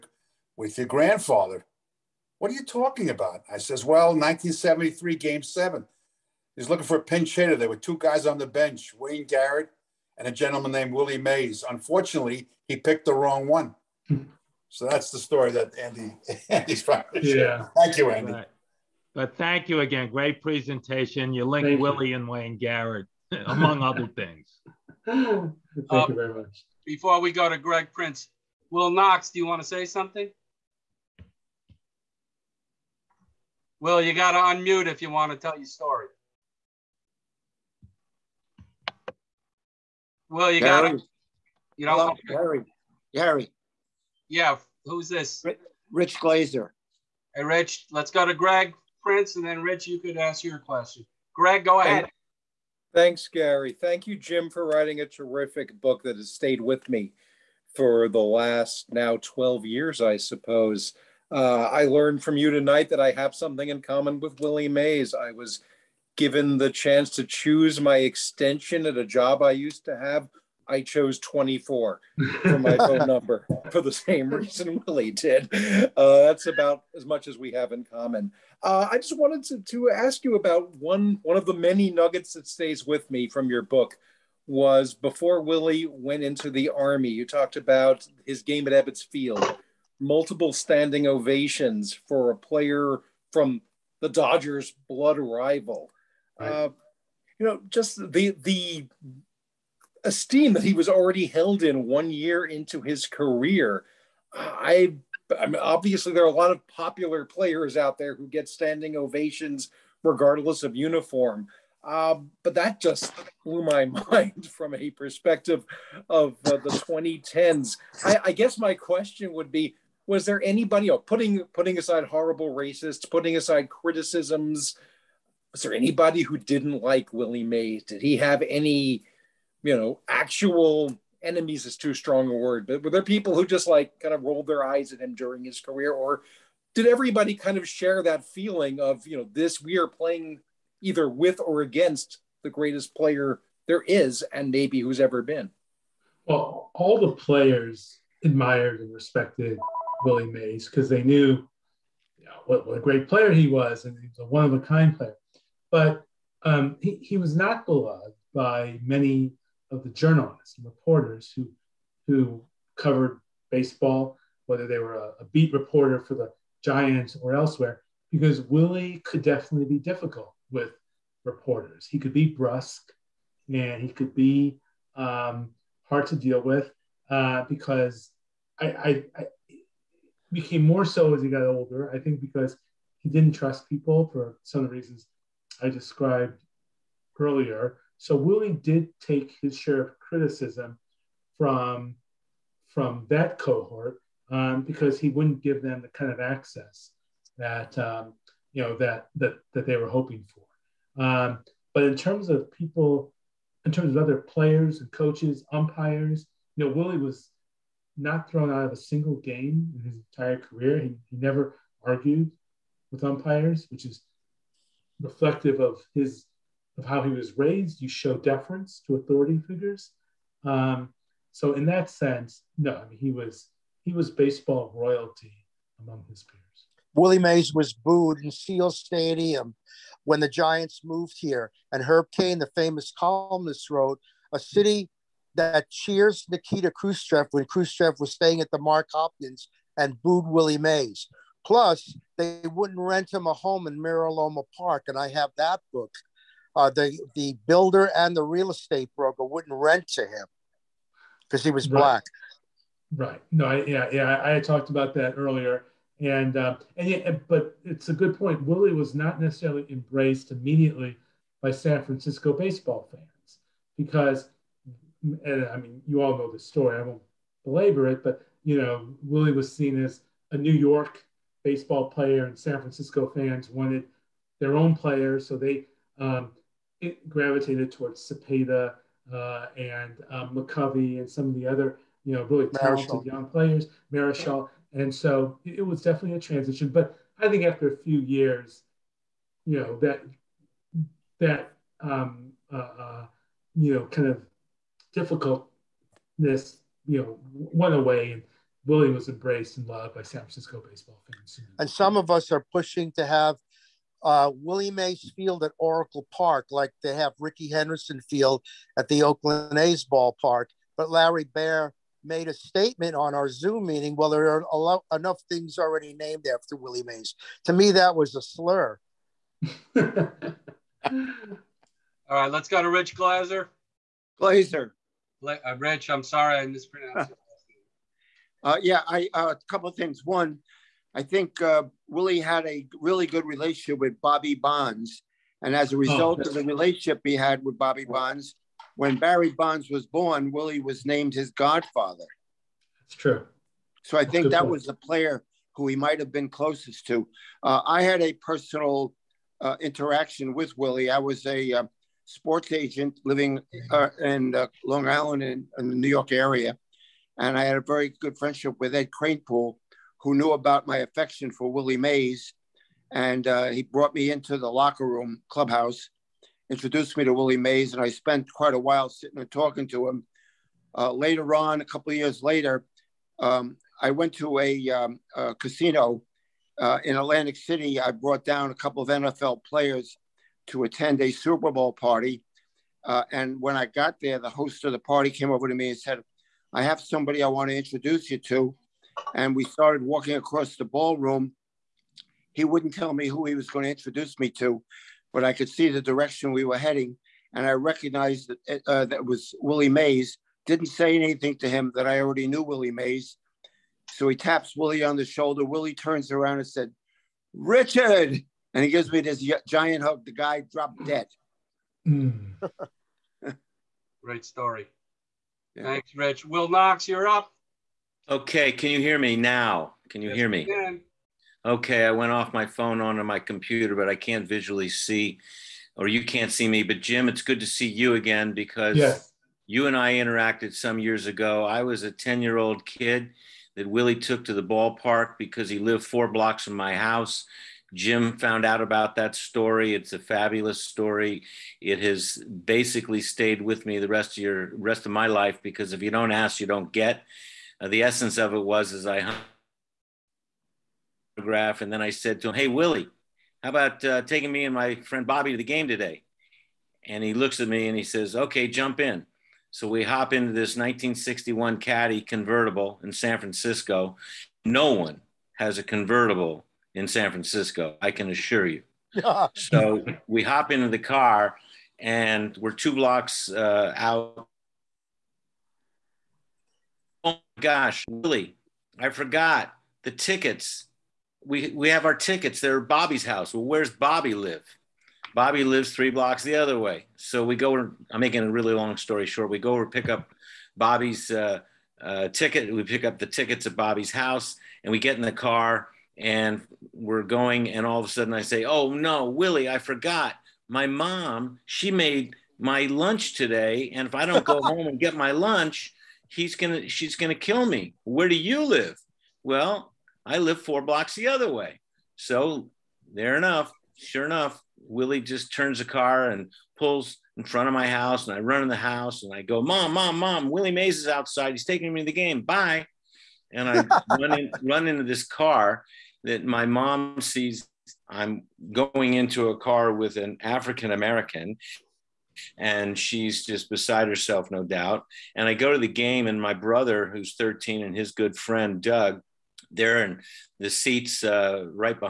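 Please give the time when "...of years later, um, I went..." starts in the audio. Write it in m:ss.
6:11.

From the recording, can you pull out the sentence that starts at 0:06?
He's looking for a pinch hitter.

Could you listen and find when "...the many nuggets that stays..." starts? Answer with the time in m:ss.
1:21.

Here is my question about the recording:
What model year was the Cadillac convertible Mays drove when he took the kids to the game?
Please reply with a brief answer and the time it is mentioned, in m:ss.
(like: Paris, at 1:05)
1961, at 7:40.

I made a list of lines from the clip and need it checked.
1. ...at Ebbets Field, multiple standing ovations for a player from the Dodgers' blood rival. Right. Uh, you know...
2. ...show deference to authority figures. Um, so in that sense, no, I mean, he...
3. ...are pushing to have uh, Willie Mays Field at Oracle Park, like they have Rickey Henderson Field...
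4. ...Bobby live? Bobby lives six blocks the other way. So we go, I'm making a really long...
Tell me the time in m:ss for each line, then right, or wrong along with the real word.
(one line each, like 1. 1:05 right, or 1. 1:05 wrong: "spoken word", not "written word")
1. 1:28 right
2. 3:37 right
3. 5:02 right
4. 8:03 wrong: "three", not "six".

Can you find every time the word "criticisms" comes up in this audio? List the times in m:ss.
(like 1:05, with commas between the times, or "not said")
2:03, 3:09.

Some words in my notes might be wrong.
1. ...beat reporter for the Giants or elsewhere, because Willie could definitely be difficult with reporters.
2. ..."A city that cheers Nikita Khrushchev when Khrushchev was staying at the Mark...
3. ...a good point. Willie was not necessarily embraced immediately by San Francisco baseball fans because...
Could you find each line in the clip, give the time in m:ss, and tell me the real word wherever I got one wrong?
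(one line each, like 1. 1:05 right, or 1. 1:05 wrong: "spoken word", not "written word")
1. 2:45 right
2. 3:54 right
3. 4:17 right.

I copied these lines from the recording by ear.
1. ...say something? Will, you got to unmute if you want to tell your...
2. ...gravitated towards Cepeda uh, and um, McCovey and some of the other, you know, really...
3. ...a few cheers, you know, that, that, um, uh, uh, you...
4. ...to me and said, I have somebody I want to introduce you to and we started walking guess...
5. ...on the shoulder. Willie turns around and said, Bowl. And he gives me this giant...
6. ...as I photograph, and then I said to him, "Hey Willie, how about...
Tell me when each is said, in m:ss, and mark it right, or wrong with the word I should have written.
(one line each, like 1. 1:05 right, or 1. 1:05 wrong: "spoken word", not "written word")
1. 0:29 right
2. 4:37 right
3. 4:47 wrong: "years", not "cheers"
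4. 6:25 wrong: "across", not "guess"
5. 6:44 wrong: "Richard", not "Bowl"
6. 7:28 right.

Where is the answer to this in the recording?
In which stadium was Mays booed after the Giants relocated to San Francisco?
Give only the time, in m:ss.
3:48.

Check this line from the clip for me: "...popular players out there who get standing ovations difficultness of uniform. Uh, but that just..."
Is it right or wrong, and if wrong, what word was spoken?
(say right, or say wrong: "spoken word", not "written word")
wrong: "regardless", not "difficultness".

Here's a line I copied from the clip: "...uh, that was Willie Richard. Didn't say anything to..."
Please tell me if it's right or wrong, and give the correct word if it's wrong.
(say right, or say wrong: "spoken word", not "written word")
wrong: "Mays", not "Richard".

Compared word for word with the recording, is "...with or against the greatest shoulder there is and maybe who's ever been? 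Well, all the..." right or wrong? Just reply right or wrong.
wrong.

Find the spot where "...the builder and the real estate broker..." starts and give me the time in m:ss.
4:07.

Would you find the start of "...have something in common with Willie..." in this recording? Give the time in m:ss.
1:03.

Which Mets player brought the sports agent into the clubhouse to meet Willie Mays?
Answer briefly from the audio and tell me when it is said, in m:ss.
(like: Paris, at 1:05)
Ed Kranepool, at 5:58.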